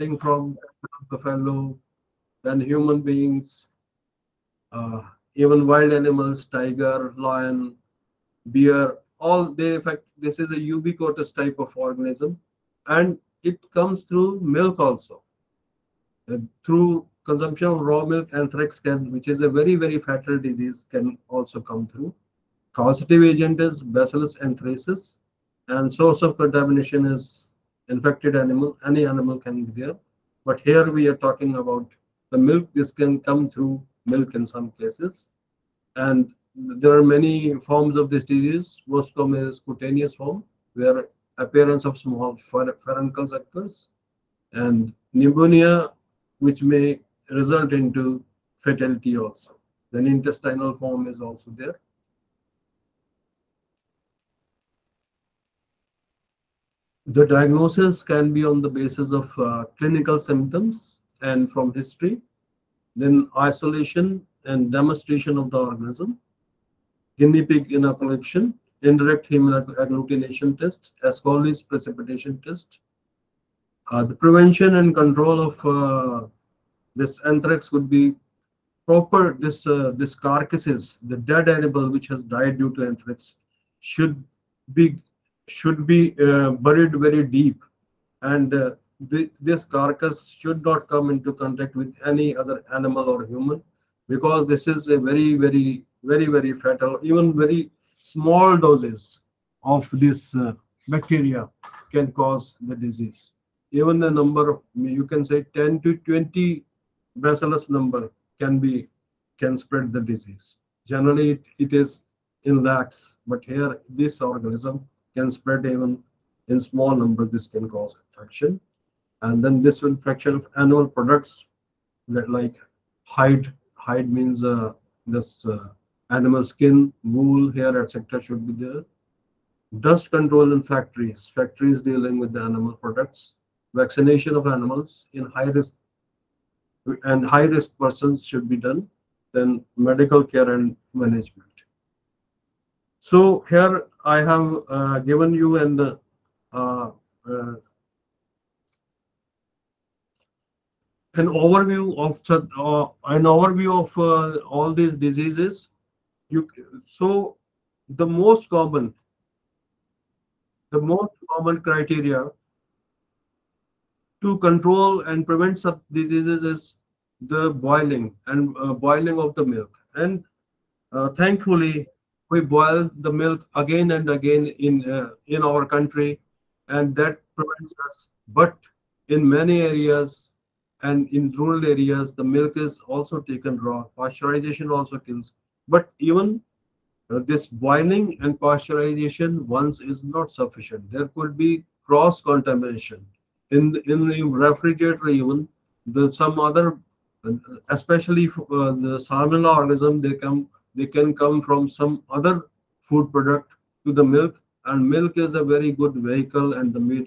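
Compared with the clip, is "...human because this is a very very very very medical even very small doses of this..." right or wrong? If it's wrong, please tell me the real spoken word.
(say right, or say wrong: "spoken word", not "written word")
wrong: "fatal", not "medical".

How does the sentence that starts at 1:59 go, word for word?
And then this will fracture of animal products that like hide, hide means uh, this uh, animal skin, wool, hair, etc.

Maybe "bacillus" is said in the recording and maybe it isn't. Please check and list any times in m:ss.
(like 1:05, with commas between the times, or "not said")
0:23, 1:47.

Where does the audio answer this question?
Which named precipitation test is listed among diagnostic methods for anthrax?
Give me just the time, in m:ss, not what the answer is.
1:11.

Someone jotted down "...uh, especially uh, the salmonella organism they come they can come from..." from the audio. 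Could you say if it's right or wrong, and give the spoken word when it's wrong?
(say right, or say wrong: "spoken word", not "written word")
right.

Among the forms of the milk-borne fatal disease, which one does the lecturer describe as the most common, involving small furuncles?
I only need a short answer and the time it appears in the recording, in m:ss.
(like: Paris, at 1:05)
Cutaneous form, at 0:39.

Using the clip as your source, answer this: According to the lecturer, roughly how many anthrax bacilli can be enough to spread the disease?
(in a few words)
10 to 20.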